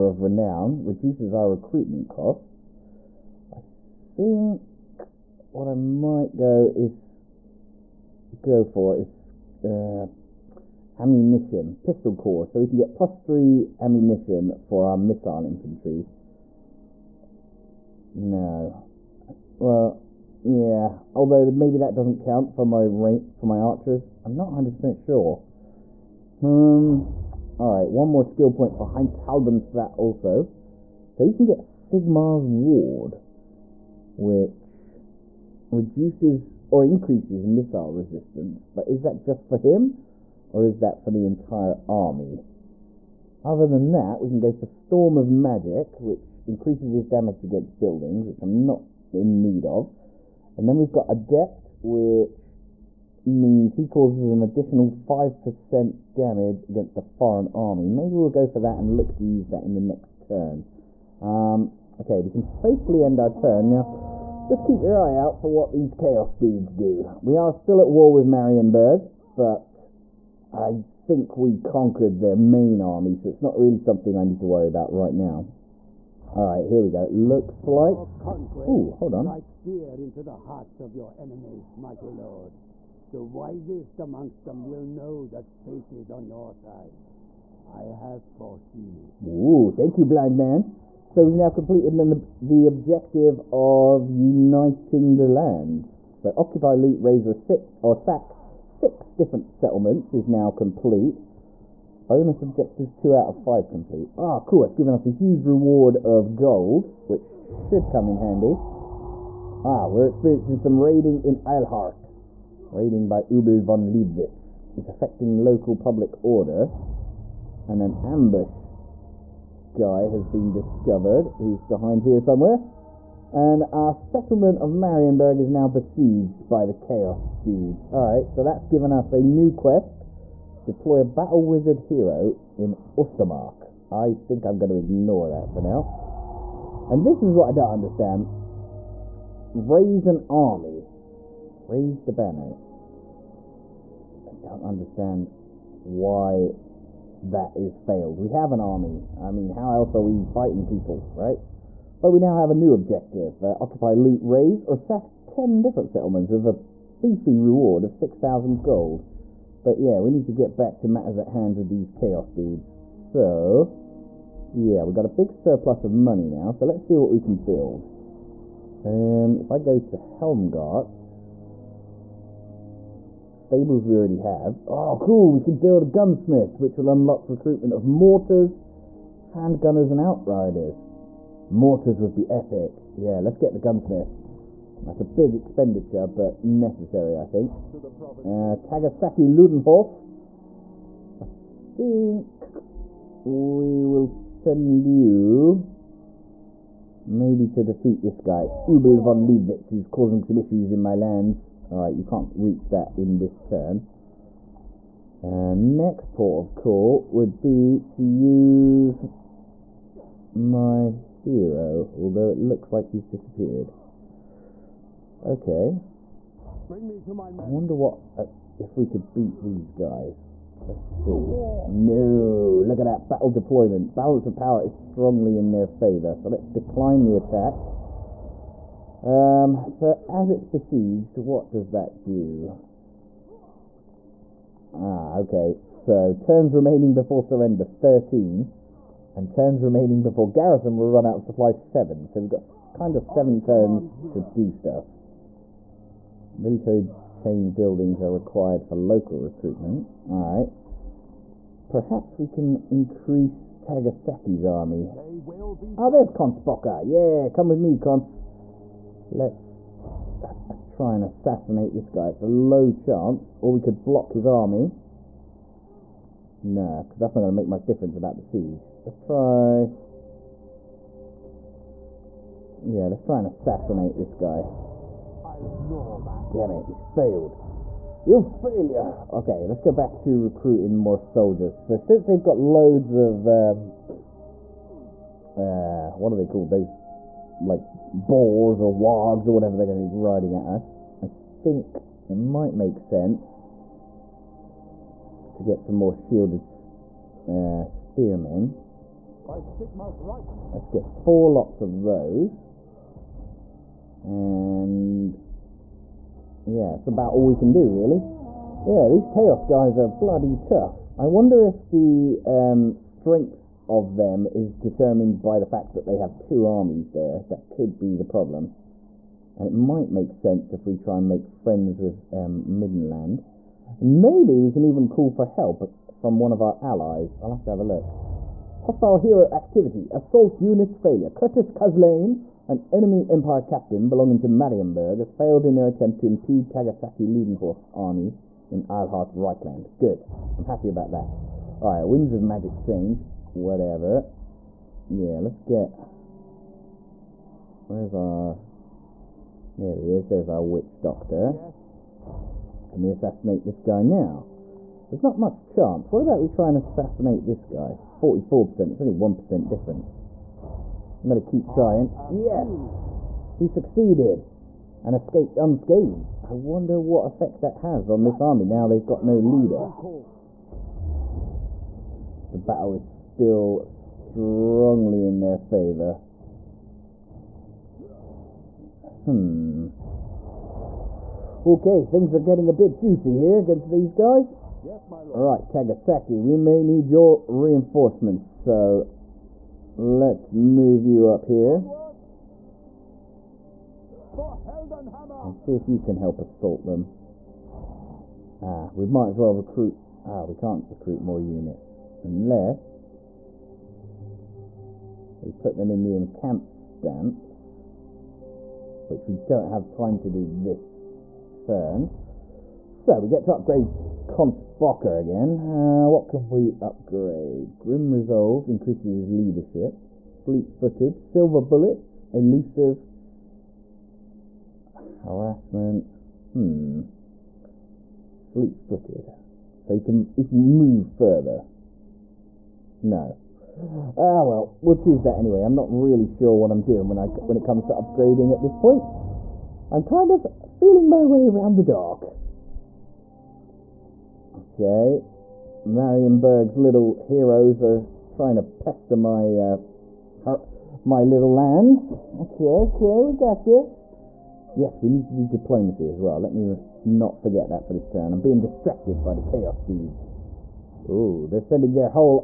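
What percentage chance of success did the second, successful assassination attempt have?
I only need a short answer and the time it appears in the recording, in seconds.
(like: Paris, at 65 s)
44%, at 357 s.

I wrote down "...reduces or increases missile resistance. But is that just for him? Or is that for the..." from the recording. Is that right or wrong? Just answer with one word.
right.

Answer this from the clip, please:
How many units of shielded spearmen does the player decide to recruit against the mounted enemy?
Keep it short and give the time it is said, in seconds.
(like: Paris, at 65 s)
4, at 300 s.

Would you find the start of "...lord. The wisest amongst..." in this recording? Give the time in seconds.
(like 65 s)
82 s.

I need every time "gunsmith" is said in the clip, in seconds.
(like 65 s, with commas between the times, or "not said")
175 s, 183 s.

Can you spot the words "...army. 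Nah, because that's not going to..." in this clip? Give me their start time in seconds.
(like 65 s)
264 s.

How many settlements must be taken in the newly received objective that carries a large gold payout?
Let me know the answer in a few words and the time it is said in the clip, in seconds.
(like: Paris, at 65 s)
10, at 155 s.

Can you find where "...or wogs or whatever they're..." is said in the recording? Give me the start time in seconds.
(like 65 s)
288 s.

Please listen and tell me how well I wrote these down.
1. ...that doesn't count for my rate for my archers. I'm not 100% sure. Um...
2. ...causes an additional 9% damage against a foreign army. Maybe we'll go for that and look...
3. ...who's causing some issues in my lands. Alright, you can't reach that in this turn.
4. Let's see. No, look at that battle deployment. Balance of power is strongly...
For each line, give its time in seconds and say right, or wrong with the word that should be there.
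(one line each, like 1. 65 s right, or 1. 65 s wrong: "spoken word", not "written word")
1. 21 s right
2. 53 s wrong: "5", not "9"
3. 199 s right
4. 220 s right.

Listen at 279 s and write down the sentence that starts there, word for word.
Okay, let's go back to recruiting more soldiers.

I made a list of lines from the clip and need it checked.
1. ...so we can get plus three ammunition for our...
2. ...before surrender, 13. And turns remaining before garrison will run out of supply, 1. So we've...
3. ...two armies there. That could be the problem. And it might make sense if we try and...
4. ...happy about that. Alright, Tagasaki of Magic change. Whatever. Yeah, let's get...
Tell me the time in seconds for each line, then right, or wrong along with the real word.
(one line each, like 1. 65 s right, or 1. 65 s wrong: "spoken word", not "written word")
1. 12 s right
2. 236 s wrong: "7", not "1"
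3. 316 s right
4. 340 s wrong: "Winds", not "Tagasaki".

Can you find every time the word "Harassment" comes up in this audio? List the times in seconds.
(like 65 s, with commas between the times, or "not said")
425 s.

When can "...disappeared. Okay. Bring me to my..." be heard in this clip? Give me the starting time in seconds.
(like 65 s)
213 s.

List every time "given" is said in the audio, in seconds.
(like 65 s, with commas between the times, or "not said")
104 s, 128 s.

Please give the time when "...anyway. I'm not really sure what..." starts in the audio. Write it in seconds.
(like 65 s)
435 s.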